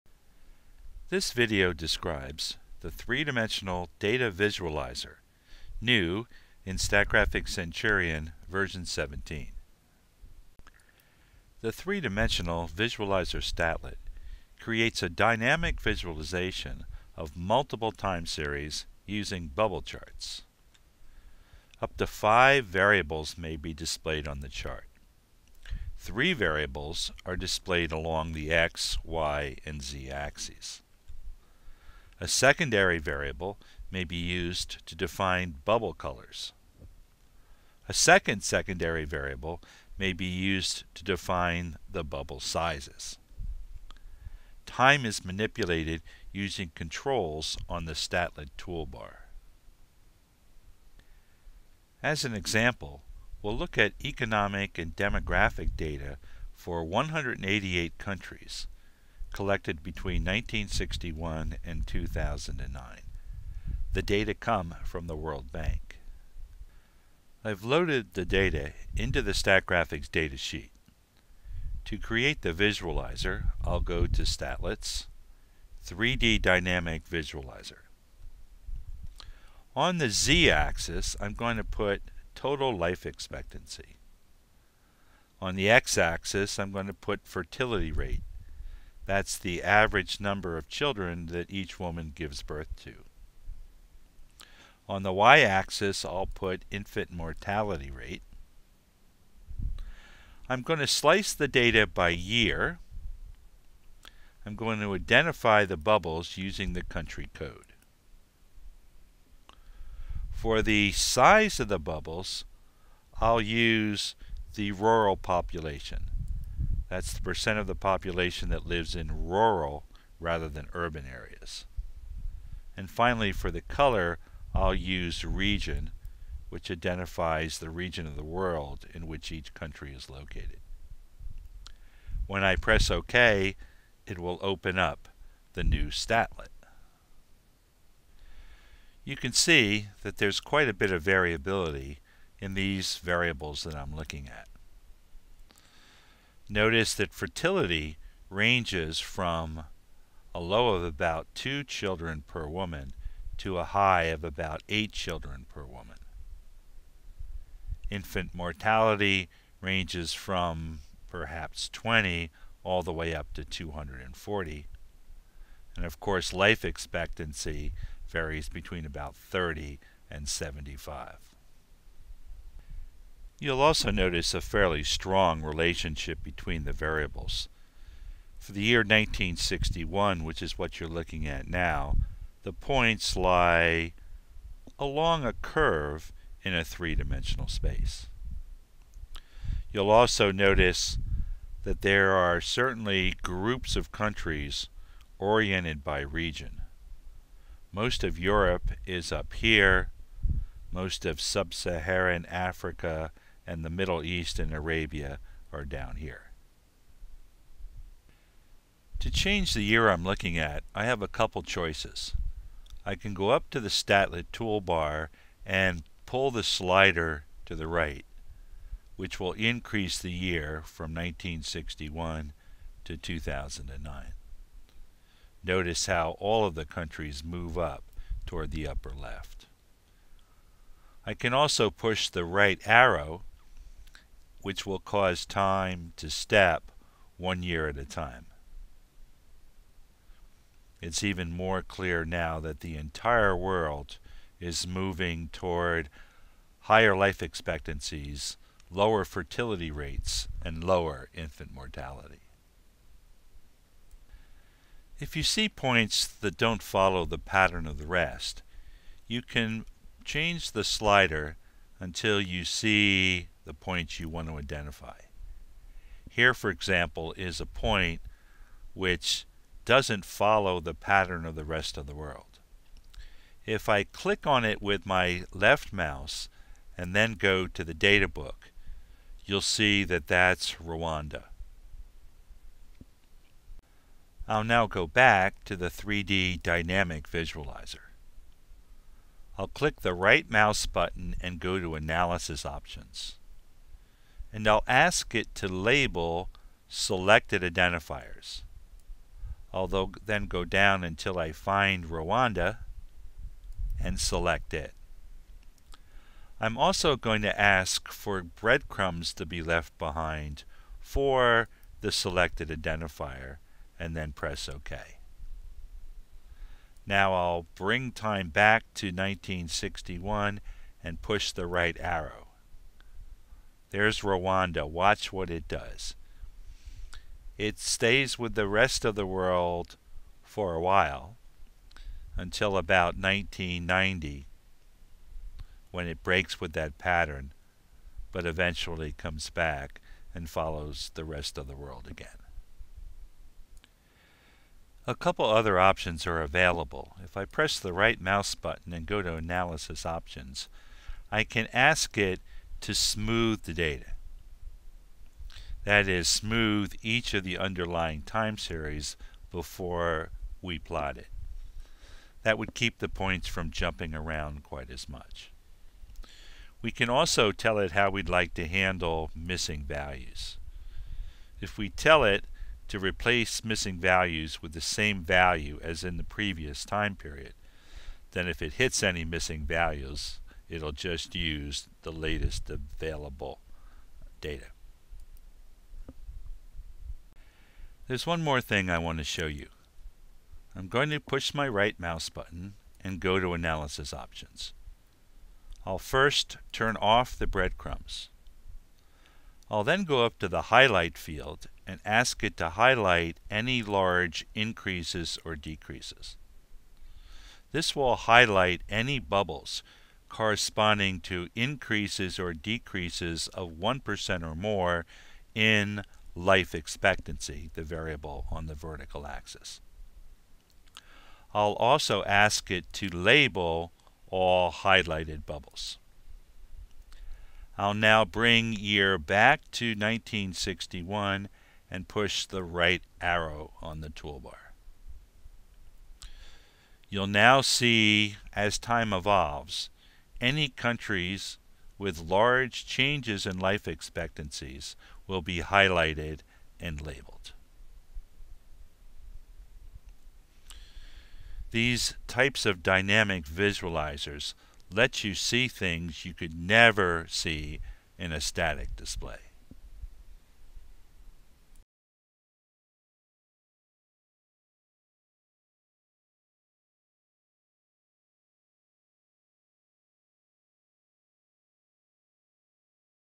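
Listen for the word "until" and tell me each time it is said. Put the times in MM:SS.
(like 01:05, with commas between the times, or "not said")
04:21, 05:00, 05:32.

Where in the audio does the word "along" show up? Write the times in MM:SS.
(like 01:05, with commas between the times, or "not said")
00:27, 03:04.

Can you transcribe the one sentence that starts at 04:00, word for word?
It's even more clear now that the entire world is moving toward higher life expectancies, lower fertility rates, and lower infant mortality.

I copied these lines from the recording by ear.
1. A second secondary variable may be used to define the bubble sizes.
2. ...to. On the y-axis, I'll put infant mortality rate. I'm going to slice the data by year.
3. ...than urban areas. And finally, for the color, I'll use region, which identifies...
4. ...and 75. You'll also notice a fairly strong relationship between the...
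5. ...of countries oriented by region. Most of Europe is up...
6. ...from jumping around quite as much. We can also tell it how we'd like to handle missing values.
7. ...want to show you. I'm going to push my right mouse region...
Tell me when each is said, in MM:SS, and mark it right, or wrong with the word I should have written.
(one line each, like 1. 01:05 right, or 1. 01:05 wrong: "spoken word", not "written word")
1. 00:37 right
2. 01:32 right
3. 02:00 right
4. 02:50 right
5. 03:13 right
6. 06:03 right
7. 06:28 wrong: "button", not "region".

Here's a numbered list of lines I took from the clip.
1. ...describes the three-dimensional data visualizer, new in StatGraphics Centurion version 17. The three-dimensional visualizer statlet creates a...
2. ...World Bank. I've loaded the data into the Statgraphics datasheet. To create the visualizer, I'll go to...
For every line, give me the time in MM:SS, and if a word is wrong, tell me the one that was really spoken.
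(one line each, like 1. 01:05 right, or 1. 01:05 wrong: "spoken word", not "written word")
1. 00:01 right
2. 01:05 right.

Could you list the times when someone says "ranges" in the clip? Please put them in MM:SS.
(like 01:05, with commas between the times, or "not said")
02:28, 02:39.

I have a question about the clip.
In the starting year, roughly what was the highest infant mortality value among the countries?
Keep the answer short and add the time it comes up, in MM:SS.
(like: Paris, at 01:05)
240, at 02:43.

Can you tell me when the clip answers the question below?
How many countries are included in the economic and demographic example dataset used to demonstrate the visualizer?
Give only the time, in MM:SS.
00:56.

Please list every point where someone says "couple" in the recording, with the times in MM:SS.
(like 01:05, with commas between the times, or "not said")
03:31, 05:44.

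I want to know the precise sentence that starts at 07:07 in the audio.
I'll now bring year back to 1961 and push the right arrow on the toolbar.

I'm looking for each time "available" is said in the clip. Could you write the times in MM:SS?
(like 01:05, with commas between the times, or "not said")
05:46, 06:22.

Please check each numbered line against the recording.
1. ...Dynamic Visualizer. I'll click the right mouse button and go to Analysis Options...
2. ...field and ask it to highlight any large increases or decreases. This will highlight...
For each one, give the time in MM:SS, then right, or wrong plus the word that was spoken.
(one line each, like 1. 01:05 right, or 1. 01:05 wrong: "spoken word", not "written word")
1. 04:46 right
2. 06:40 right.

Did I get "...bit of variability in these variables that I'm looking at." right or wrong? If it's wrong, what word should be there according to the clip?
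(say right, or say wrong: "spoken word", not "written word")
right.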